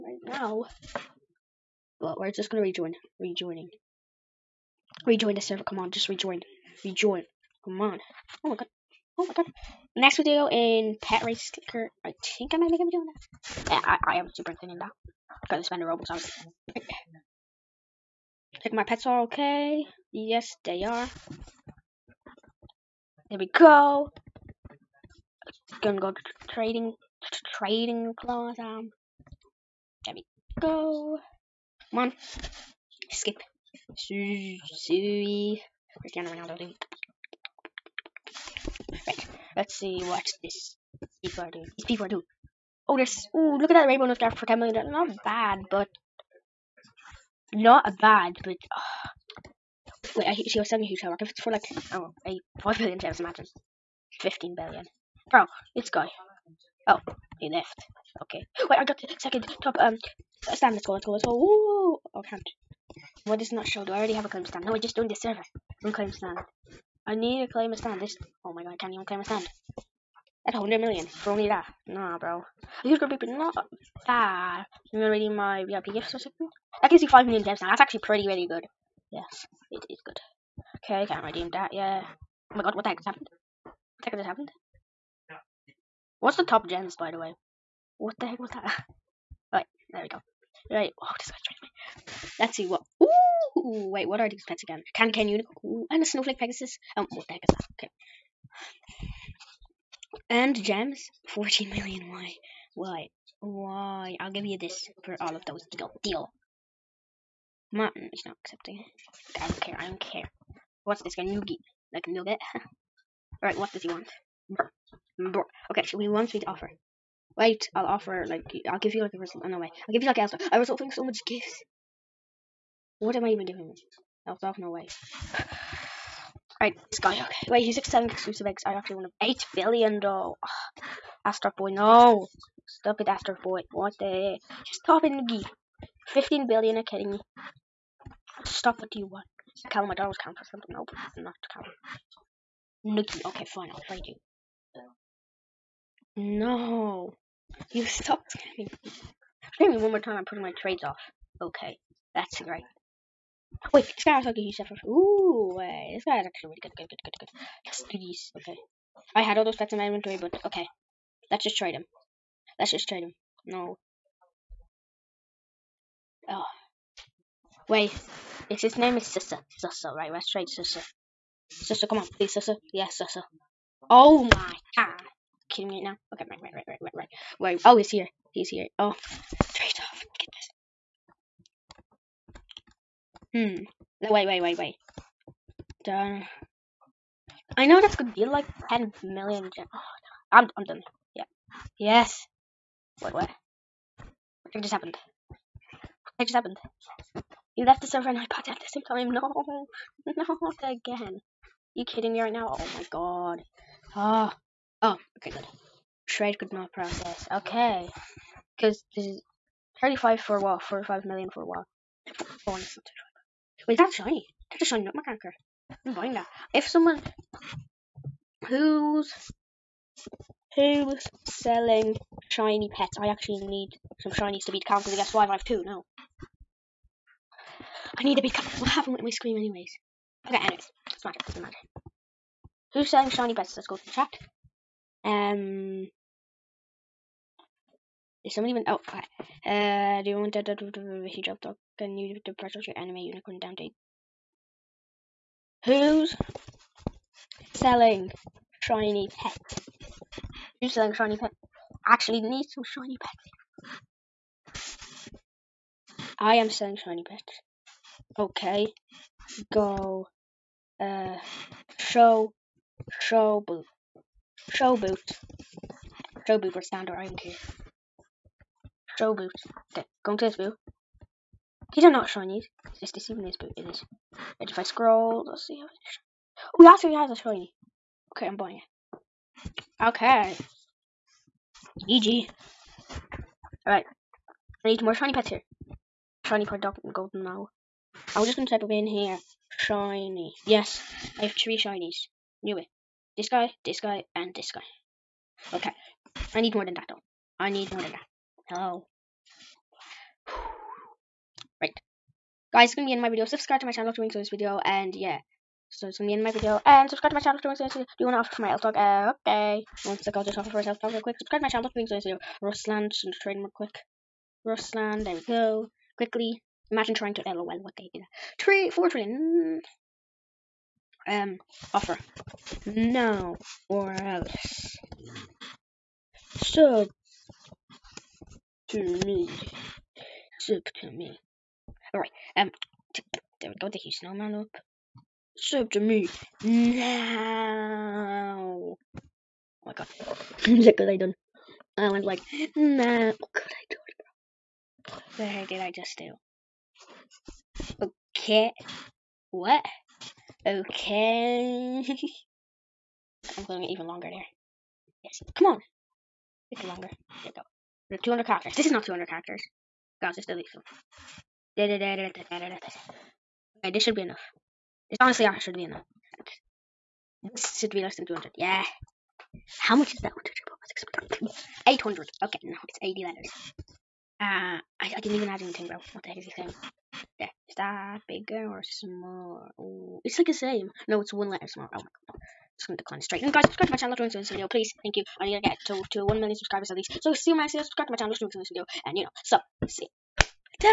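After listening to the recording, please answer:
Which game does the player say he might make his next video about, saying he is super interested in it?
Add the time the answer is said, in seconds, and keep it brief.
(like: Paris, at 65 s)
Pet Race Clicker, at 11 s.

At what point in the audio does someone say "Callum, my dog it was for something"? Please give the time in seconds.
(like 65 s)
139 s.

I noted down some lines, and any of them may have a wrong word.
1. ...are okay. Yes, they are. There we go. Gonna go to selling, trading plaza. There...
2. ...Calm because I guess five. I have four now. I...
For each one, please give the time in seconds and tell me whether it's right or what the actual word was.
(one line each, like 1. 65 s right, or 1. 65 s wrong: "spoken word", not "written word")
1. 19 s wrong: "trading", not "selling"
2. 224 s wrong: "two", not "four".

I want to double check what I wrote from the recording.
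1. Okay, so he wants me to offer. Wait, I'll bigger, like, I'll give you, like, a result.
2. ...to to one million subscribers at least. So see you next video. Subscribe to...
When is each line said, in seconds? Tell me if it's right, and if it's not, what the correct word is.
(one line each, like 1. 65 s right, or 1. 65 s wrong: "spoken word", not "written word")
1. 115 s wrong: "offer", not "bigger"
2. 385 s right.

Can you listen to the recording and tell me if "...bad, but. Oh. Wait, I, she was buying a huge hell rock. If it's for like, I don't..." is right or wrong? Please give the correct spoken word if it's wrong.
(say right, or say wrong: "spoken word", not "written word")
wrong: "selling", not "buying".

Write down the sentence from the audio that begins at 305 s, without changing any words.
So it's gonna be end my video and subscribe to my channel after doing so this video.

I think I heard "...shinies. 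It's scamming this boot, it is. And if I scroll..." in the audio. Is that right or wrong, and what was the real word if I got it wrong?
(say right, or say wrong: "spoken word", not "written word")
wrong: "deceiving", not "scamming".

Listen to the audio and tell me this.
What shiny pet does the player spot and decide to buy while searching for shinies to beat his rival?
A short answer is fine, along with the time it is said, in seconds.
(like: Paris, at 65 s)
Shiny nutmeg anchor, at 214 s.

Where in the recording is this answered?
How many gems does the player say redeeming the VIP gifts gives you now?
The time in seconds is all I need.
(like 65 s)
77 s.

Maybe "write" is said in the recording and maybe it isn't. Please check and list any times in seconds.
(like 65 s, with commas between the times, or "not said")
not said.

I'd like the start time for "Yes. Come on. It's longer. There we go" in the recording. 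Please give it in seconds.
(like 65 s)
355 s.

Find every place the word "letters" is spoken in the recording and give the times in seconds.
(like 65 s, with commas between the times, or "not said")
373 s, 381 s.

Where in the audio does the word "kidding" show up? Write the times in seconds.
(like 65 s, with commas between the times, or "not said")
136 s, 175 s, 201 s.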